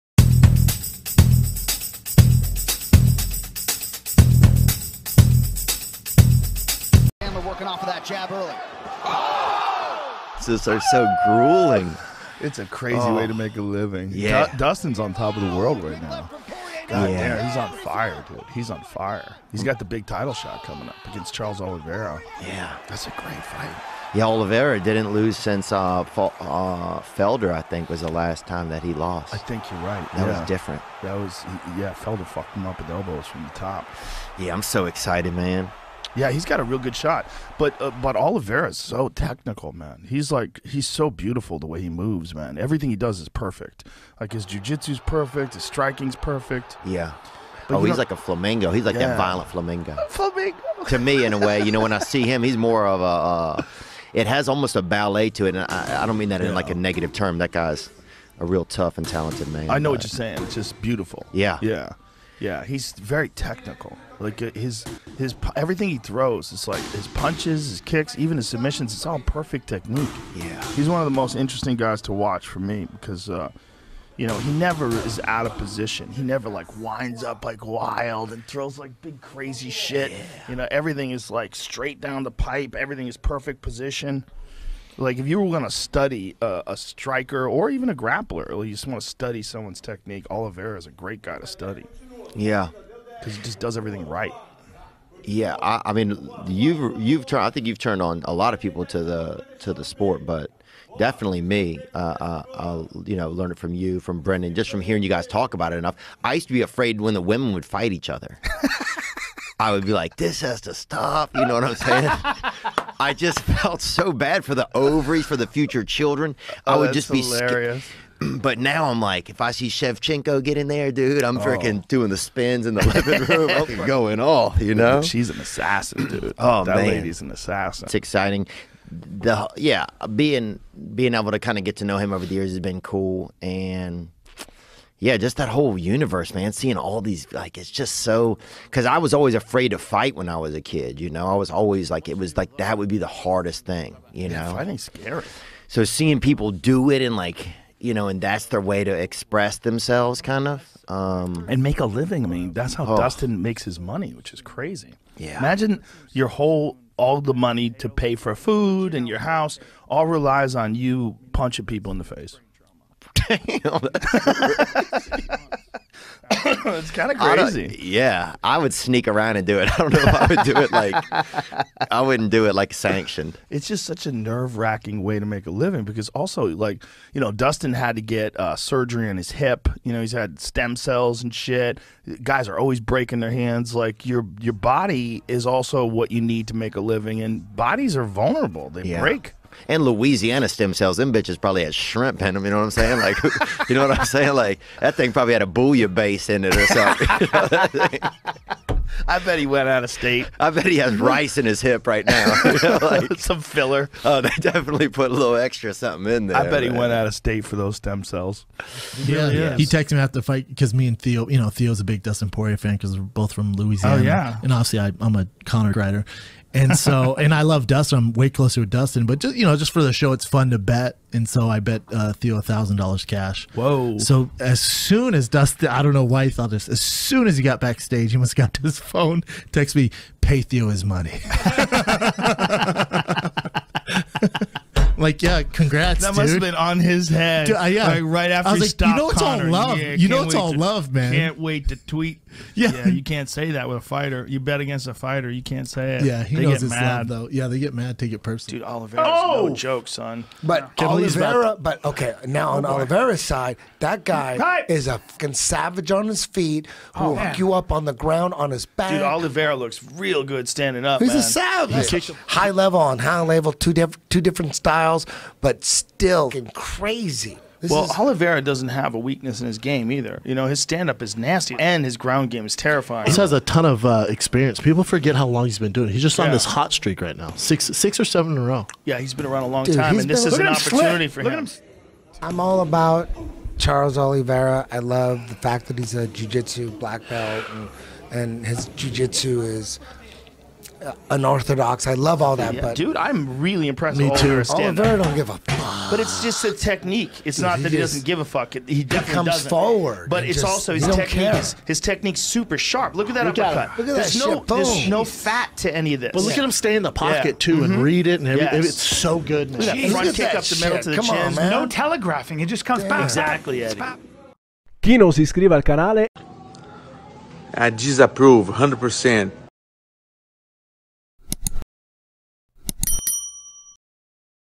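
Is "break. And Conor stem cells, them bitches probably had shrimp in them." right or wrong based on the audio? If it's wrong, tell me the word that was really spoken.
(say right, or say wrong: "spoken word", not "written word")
wrong: "Louisiana", not "Conor".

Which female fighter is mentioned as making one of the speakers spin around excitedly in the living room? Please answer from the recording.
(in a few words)
Shevchenko.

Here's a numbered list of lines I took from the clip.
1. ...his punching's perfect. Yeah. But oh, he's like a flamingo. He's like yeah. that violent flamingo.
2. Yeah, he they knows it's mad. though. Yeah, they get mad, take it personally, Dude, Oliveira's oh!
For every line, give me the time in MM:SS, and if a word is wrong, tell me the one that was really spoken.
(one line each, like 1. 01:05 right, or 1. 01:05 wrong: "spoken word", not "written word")
1. 00:45 wrong: "striking", not "punching"
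2. 04:06 right.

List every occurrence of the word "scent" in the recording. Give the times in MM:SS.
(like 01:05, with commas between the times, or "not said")
not said.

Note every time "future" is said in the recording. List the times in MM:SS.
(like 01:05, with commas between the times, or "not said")
01:55.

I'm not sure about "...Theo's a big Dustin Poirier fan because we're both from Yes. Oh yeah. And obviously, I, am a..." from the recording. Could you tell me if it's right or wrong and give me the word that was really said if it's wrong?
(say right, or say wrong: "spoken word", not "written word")
wrong: "Louisiana", not "Yes".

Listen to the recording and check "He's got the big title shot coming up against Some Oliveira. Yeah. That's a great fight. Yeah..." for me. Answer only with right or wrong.
wrong.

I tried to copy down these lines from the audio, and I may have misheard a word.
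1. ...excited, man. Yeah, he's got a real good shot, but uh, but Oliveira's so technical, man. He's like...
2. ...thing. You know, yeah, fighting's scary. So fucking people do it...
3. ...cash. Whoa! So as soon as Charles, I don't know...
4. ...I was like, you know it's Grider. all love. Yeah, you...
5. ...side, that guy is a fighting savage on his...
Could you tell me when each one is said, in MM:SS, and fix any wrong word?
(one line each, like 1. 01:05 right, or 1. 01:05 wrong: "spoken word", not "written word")
1. 00:34 right
2. 02:23 wrong: "seeing", not "fucking"
3. 03:43 wrong: "Dustin", not "Charles"
4. 03:58 wrong: "Connor", not "Grider"
5. 04:13 wrong: "fucking", not "fighting".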